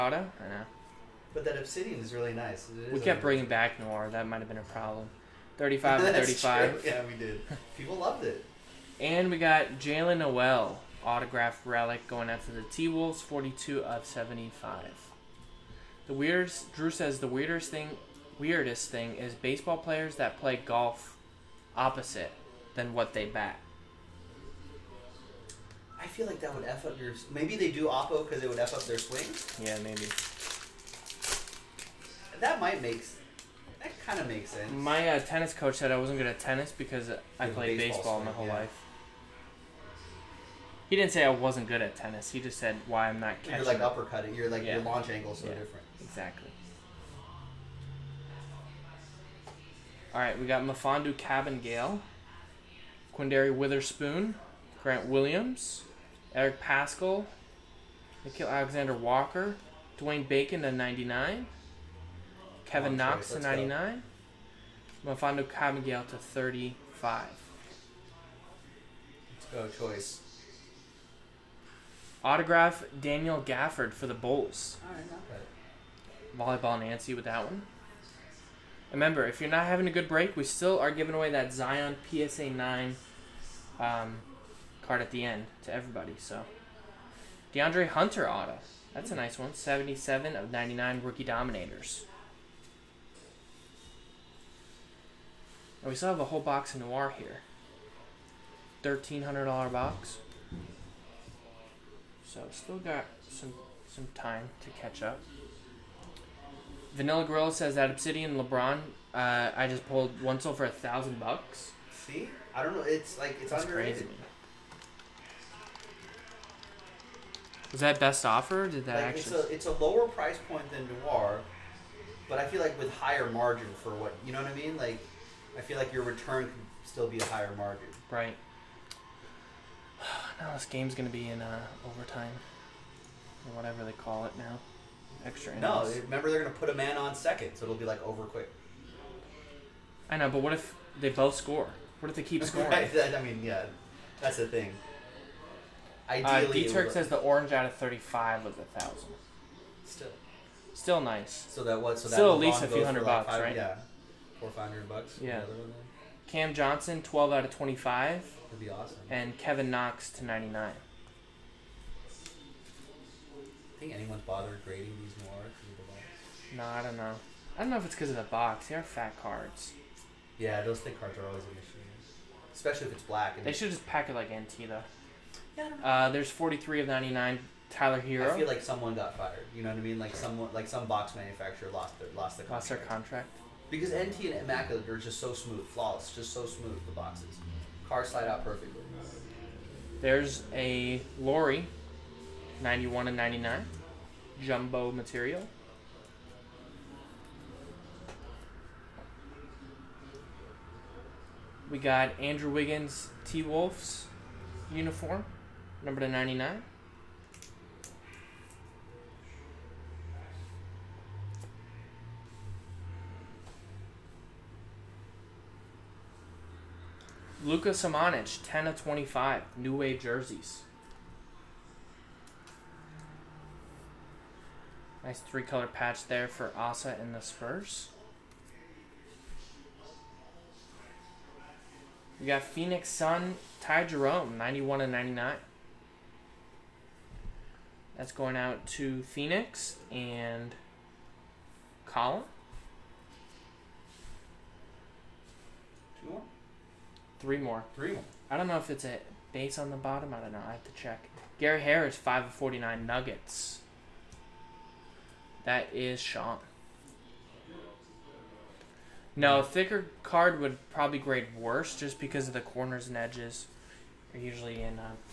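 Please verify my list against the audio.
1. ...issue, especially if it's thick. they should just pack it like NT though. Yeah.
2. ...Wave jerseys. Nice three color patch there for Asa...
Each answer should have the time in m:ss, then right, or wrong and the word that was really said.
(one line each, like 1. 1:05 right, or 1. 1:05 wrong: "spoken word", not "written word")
1. 2:51 wrong: "black", not "thick"
2. 3:39 right.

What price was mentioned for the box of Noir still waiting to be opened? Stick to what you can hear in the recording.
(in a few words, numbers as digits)
$1,300.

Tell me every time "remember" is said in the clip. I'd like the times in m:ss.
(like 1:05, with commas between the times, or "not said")
1:18, 2:16.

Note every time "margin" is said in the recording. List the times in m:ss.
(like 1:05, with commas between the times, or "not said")
2:03, 2:07.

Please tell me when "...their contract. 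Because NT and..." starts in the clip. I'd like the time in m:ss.
3:02.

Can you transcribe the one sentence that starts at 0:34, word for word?
My uh, tennis coach said I wasn't good at tennis because I yeah, played baseball, baseball swing, my whole yeah.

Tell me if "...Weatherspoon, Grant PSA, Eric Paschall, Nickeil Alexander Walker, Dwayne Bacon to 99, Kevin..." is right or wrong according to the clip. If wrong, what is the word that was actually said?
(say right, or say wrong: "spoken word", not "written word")
wrong: "Williams", not "PSA".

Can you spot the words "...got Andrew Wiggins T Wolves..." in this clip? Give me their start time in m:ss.
3:21.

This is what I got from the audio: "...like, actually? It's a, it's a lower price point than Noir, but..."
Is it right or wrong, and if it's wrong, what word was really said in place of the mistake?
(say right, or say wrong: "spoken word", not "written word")
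right.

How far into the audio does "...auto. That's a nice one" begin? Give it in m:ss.
1:28.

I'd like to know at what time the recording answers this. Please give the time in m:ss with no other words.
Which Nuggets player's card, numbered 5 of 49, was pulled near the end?
4:11.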